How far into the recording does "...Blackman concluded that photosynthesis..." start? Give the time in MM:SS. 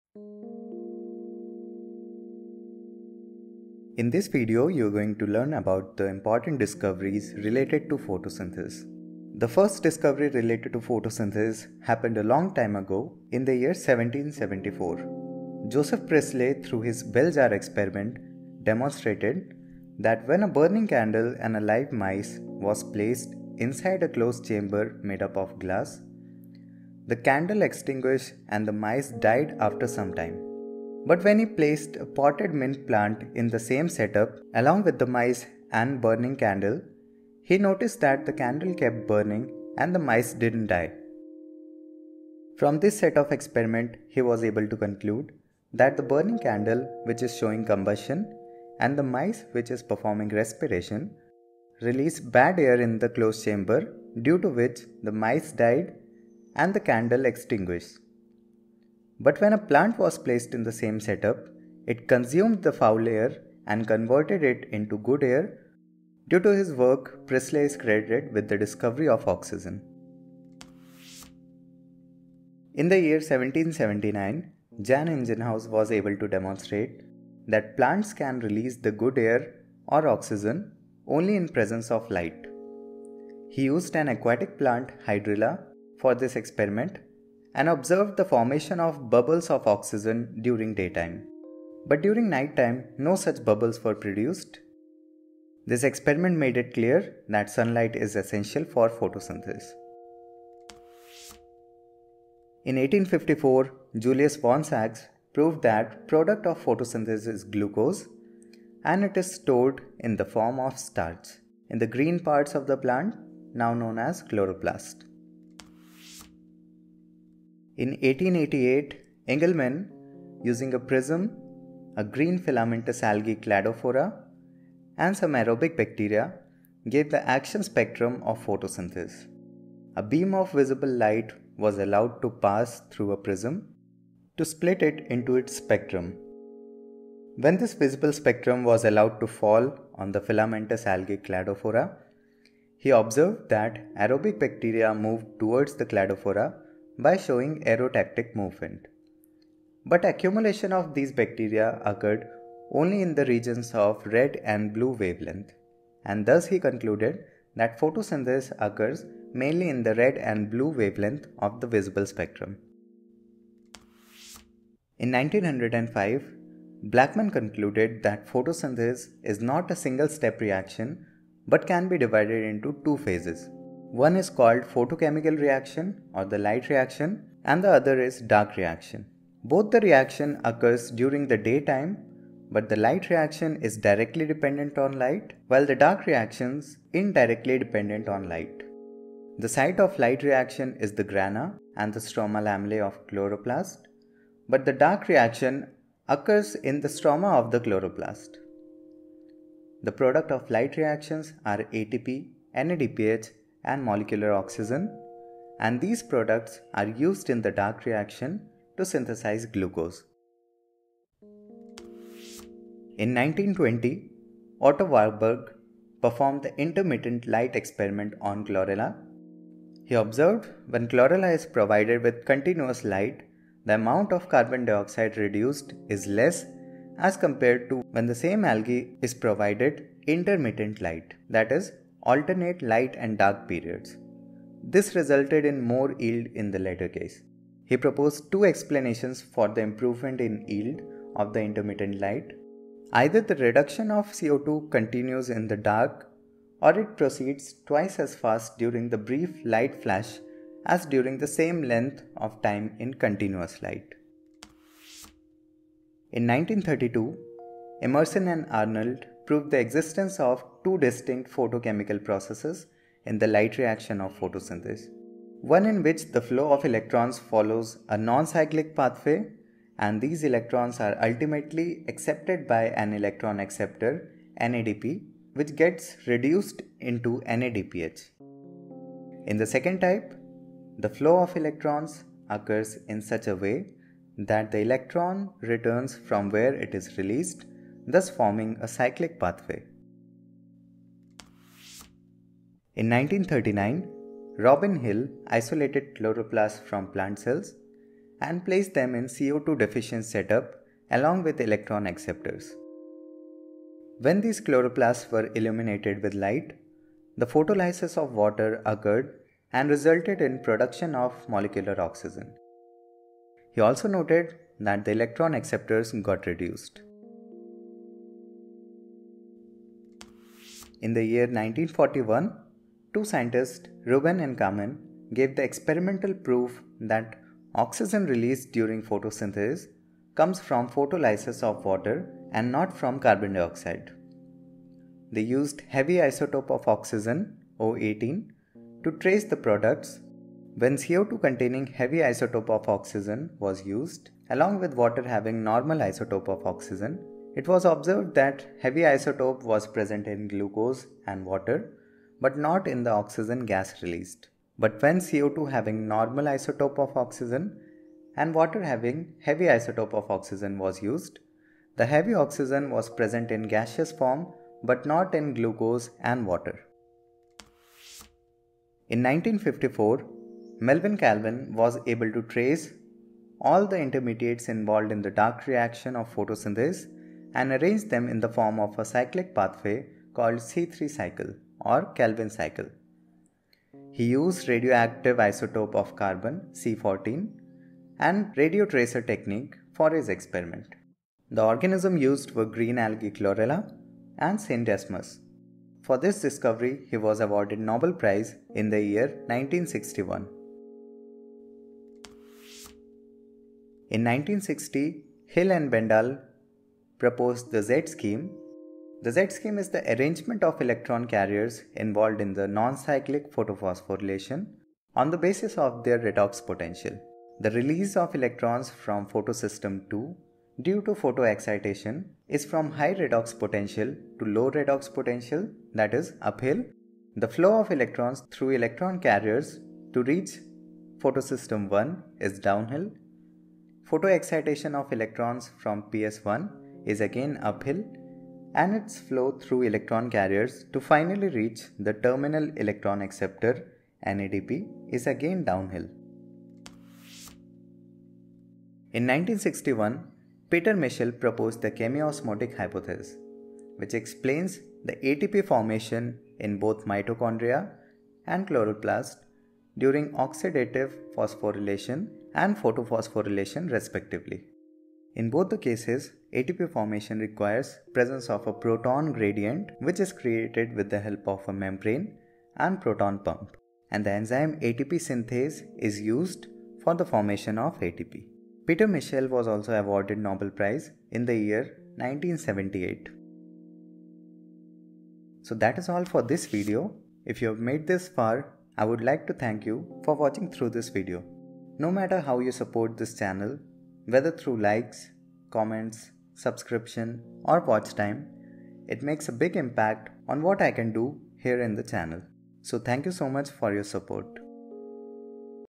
02:46.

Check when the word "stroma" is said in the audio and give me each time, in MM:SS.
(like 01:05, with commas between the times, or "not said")
03:12, 03:16.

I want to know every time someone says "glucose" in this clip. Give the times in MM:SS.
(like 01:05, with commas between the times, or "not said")
01:47, 03:29, 05:50, 06:05.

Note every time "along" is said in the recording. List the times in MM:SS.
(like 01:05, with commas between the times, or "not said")
00:34, 05:00, 05:44.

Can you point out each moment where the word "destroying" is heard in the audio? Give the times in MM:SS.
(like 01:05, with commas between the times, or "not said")
not said.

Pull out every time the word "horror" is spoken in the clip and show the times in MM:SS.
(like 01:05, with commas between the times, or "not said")
not said.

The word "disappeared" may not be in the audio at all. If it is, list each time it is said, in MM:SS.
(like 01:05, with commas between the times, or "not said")
not said.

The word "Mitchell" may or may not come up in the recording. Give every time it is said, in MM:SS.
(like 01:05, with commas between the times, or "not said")
07:30, 07:58.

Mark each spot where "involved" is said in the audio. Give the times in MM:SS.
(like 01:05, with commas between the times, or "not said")
06:14, 06:51.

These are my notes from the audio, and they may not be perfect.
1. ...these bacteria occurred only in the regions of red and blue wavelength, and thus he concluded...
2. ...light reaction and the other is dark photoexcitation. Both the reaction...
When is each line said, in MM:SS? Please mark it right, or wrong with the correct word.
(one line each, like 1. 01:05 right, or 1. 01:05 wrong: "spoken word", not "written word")
1. 02:30 right
2. 02:56 wrong: "reaction", not "photoexcitation".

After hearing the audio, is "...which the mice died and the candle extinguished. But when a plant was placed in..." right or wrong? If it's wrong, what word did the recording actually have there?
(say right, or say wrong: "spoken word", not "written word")
right.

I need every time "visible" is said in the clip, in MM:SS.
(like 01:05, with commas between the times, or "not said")
02:10, 02:17, 02:41.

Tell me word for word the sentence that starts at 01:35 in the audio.
This experiment made it clear that sunlight is essential for photosynthesis.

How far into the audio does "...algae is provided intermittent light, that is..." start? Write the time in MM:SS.
03:48.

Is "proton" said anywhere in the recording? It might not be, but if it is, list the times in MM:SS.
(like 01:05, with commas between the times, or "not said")
07:48, 07:52.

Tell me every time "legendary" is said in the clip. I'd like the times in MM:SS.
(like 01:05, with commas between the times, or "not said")
not said.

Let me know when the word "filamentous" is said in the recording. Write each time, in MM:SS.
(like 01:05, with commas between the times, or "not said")
02:02, 02:20.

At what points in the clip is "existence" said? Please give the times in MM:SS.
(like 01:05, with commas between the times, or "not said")
04:19.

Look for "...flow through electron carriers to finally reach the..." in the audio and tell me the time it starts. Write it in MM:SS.
07:18.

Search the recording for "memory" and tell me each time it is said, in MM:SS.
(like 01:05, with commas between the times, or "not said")
not said.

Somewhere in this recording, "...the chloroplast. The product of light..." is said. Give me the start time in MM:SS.
03:17.